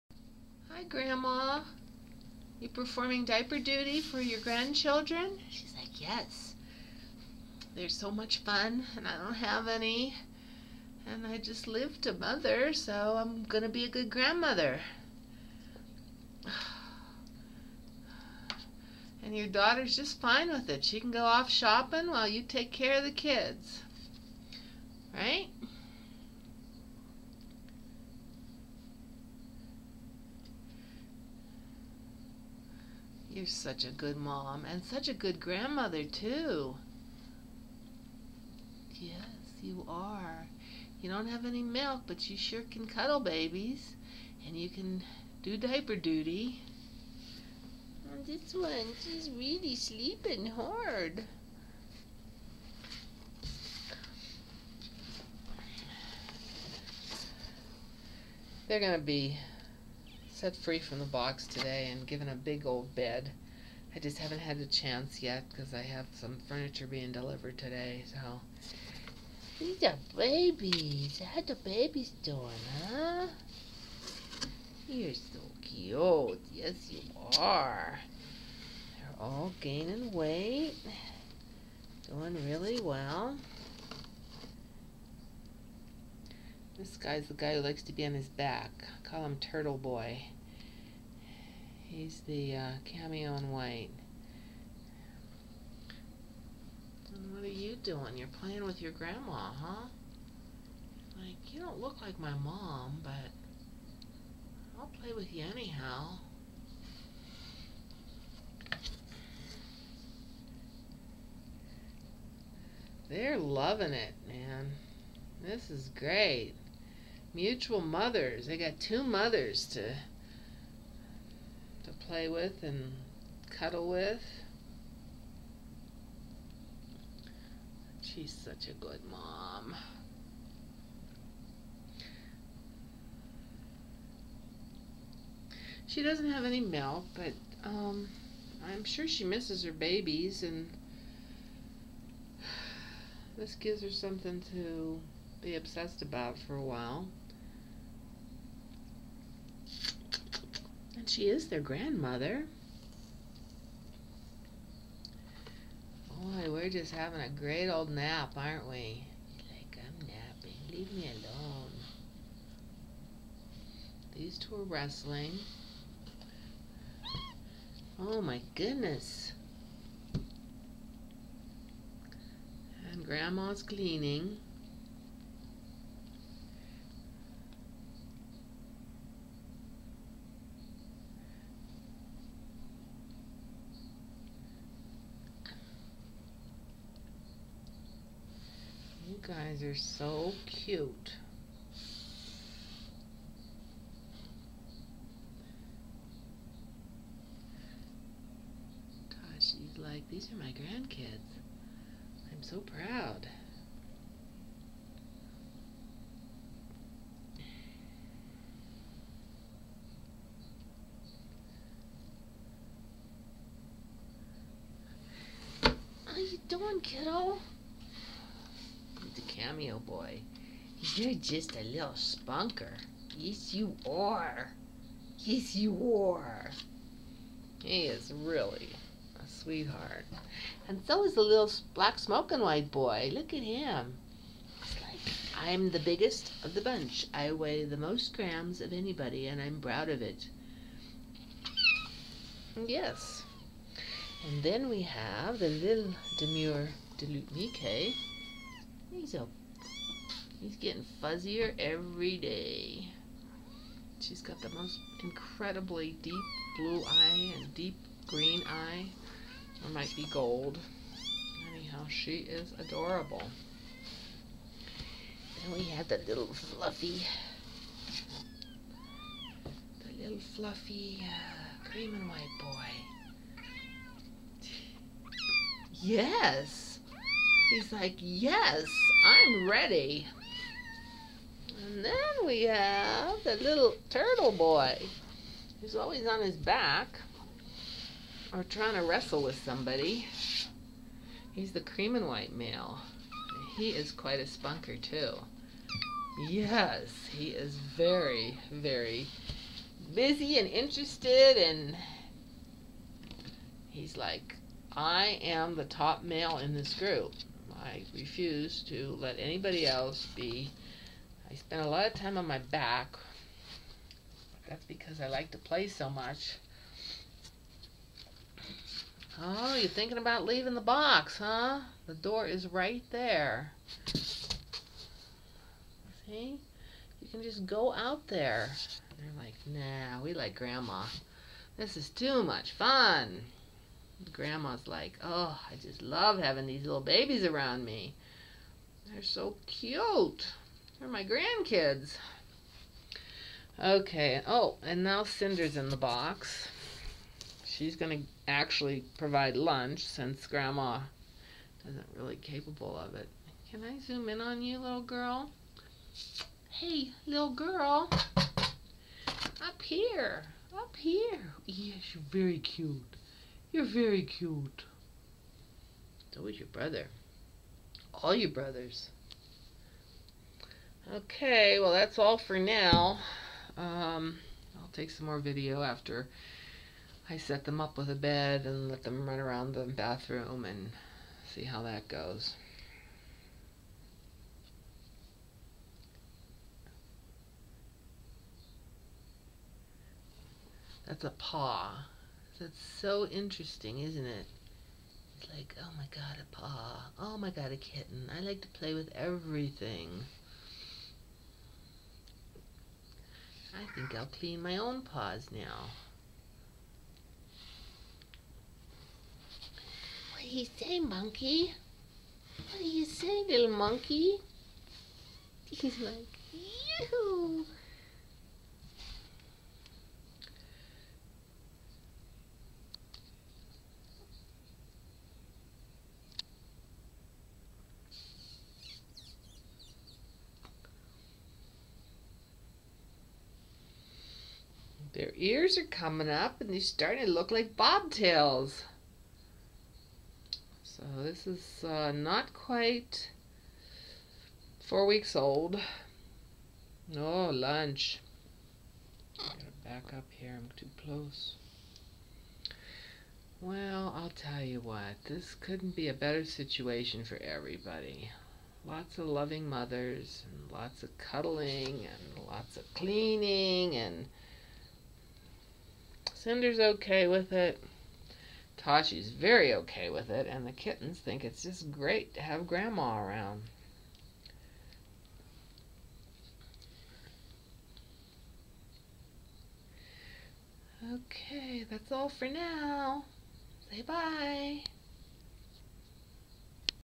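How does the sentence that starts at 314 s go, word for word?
That's because I like to play so much.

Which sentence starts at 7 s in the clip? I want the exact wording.
They're so much fun, and I don't have any.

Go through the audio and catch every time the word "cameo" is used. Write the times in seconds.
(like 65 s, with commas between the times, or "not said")
92 s, 219 s.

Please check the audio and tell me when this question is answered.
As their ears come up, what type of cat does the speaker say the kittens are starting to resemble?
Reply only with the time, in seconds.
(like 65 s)
437 s.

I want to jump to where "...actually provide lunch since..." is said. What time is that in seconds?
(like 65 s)
348 s.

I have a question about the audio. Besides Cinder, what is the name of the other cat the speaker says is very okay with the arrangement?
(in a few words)
Tashi.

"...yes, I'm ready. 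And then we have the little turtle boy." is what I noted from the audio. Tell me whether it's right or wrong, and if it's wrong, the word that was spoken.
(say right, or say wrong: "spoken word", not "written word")
right.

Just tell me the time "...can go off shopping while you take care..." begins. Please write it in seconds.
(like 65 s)
20 s.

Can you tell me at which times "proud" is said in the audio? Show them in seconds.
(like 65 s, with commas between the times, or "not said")
202 s, 239 s.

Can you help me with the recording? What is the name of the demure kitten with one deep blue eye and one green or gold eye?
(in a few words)
Mickey.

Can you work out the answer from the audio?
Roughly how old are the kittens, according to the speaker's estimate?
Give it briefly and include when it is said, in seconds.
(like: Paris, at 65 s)
Not quite 4 weeks, at 441 s.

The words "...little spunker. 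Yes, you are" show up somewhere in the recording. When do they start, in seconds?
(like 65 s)
221 s.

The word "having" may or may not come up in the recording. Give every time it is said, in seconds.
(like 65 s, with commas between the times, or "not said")
156 s, 336 s.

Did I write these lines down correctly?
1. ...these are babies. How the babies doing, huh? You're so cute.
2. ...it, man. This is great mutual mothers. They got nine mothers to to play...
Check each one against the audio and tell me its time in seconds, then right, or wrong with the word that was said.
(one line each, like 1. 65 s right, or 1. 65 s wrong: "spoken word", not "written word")
1. 69 s right
2. 113 s wrong: "two", not "nine".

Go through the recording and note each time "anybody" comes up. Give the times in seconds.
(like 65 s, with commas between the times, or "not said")
238 s, 309 s.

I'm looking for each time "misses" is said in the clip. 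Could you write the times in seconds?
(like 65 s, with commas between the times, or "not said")
139 s.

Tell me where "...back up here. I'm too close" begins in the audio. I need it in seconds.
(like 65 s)
449 s.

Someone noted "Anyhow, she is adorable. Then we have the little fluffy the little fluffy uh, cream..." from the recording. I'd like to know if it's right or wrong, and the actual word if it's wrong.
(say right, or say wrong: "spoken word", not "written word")
right.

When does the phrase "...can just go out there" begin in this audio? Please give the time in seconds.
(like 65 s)
327 s.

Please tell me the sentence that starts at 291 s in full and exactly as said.
He's the cream and white male.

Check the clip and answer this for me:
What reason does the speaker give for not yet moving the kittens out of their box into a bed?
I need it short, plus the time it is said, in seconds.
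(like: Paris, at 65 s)
Furniture being delivered, at 66 s.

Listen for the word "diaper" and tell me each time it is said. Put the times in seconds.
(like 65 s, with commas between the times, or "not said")
3 s, 45 s.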